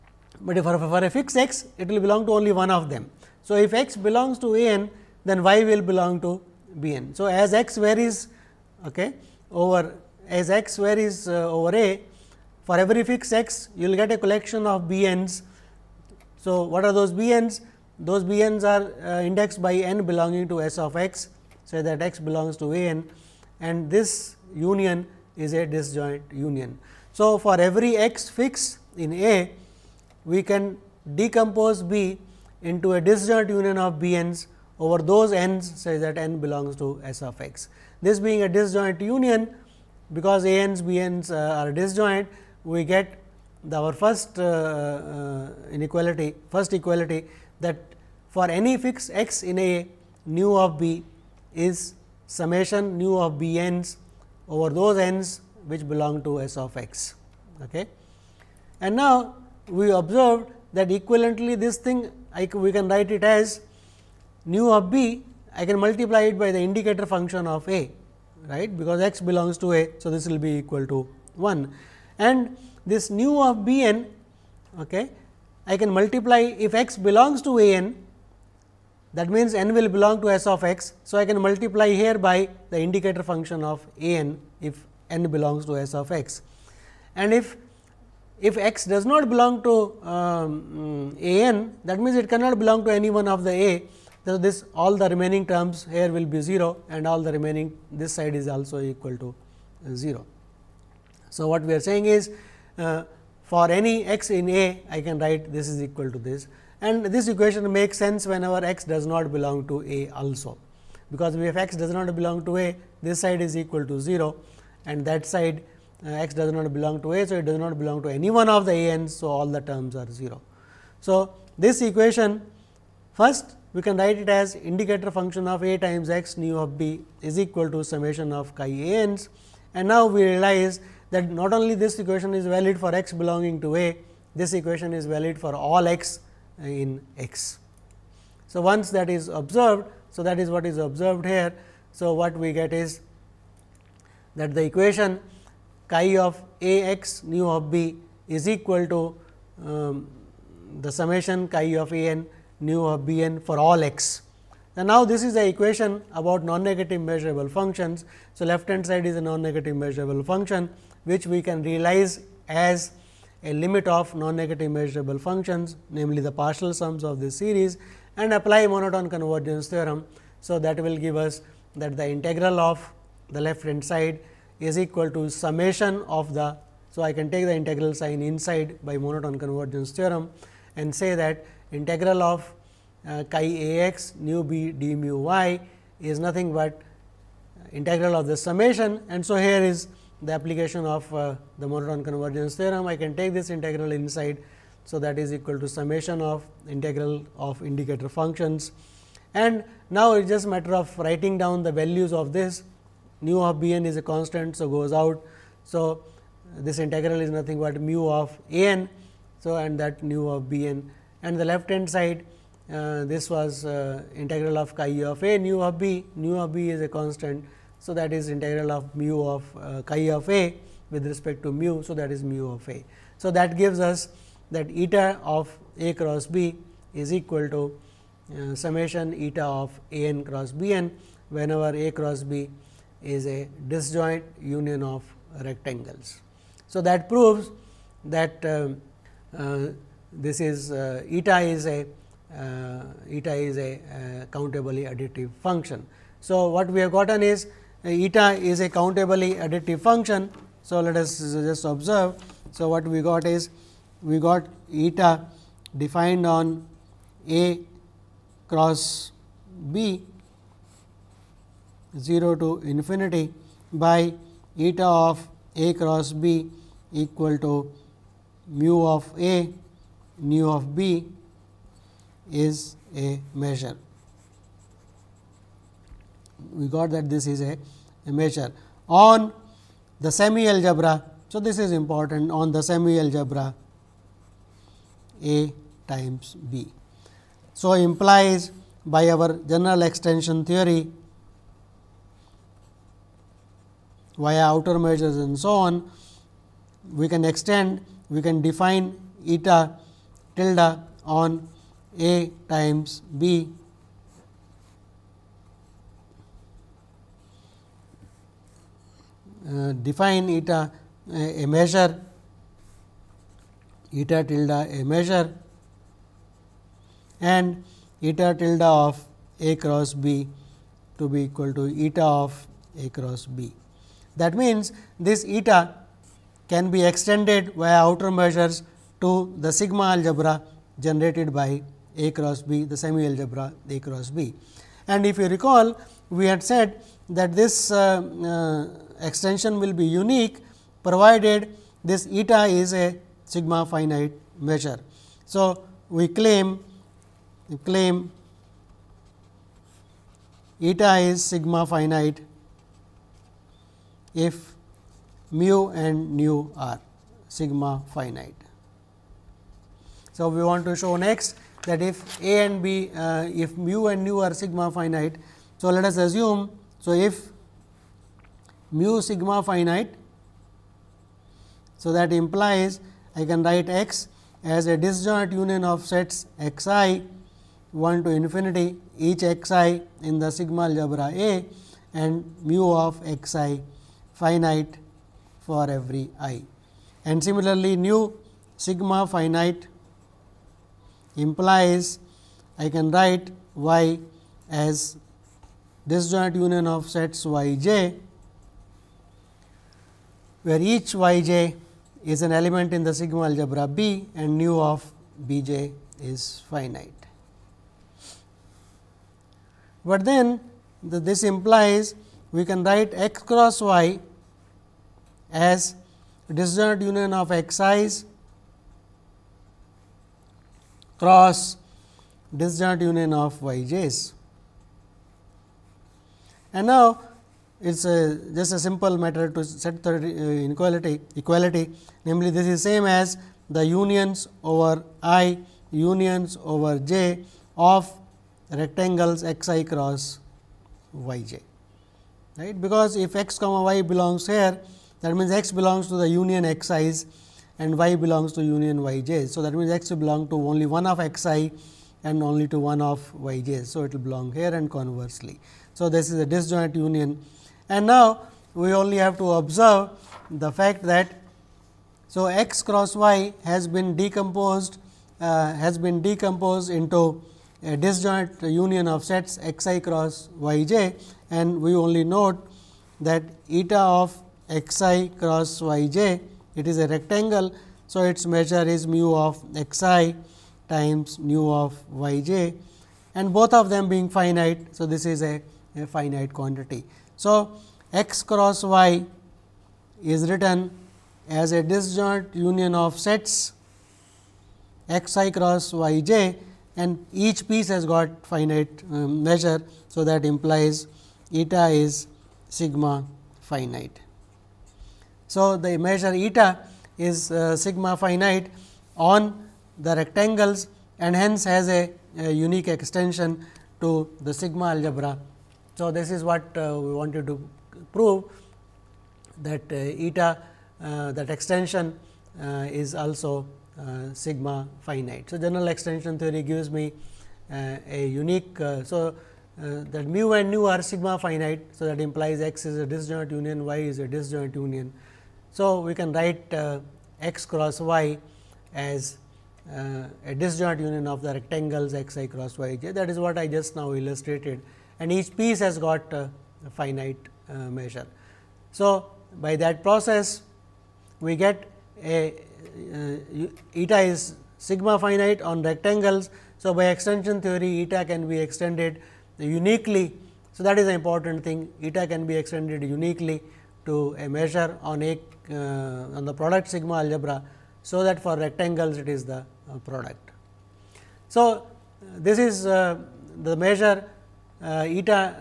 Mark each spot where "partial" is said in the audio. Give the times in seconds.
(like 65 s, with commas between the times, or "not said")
166 s.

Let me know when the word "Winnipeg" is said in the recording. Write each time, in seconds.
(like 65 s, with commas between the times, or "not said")
not said.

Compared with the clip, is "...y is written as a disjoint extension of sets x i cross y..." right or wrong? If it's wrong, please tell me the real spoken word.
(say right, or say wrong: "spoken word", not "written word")
wrong: "union", not "extension".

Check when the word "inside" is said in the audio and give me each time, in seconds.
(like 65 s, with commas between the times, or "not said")
178 s, 193 s.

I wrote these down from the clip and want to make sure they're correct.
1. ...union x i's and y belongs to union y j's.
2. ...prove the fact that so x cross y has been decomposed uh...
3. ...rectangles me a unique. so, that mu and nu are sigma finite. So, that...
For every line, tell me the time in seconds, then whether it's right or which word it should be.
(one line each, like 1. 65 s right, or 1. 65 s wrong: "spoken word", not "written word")
1. 446 s right
2. 459 s wrong: "observe", not "prove"
3. 526 s wrong: "gives", not "rectangles".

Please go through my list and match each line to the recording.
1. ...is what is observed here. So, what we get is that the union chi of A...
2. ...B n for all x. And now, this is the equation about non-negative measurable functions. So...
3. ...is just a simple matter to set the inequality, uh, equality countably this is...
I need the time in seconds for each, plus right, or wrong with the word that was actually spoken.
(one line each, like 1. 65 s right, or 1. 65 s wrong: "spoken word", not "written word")
1. 140 s wrong: "equation", not "union"
2. 153 s right
3. 427 s wrong: "namely", not "countably".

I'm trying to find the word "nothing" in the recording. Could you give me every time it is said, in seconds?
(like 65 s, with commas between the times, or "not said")
186 s, 207 s.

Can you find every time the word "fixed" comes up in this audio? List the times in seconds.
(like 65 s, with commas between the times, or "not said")
1 s, 13 s, 28 s, 48 s.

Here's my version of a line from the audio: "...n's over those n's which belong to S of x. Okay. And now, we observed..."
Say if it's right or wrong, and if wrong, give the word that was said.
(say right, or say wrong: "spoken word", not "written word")
right.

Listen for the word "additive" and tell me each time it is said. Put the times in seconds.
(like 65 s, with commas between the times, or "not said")
244 s, 249 s.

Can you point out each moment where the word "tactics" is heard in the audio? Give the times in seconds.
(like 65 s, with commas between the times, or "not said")
not said.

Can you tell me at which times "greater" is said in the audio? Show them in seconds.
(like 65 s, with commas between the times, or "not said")
not said.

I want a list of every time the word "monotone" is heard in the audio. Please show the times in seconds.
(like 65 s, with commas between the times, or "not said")
168 s, 178 s, 191 s.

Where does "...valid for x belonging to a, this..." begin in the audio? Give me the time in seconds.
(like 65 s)
132 s.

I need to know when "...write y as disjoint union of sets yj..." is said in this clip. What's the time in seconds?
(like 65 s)
392 s.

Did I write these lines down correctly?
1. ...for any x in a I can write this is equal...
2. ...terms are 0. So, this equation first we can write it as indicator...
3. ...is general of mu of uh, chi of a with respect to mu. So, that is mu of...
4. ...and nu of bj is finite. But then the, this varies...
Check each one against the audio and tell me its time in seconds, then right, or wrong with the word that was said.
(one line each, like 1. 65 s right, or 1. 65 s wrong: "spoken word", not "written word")
1. 103 s right
2. 119 s right
3. 218 s wrong: "integral", not "general"
4. 404 s wrong: "implies", not "varies".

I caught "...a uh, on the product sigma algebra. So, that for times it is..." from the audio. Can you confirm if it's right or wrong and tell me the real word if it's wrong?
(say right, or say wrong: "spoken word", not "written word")
wrong: "rectangles", not "times".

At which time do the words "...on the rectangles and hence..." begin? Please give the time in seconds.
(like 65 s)
508 s.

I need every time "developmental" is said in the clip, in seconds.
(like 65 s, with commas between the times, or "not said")
not said.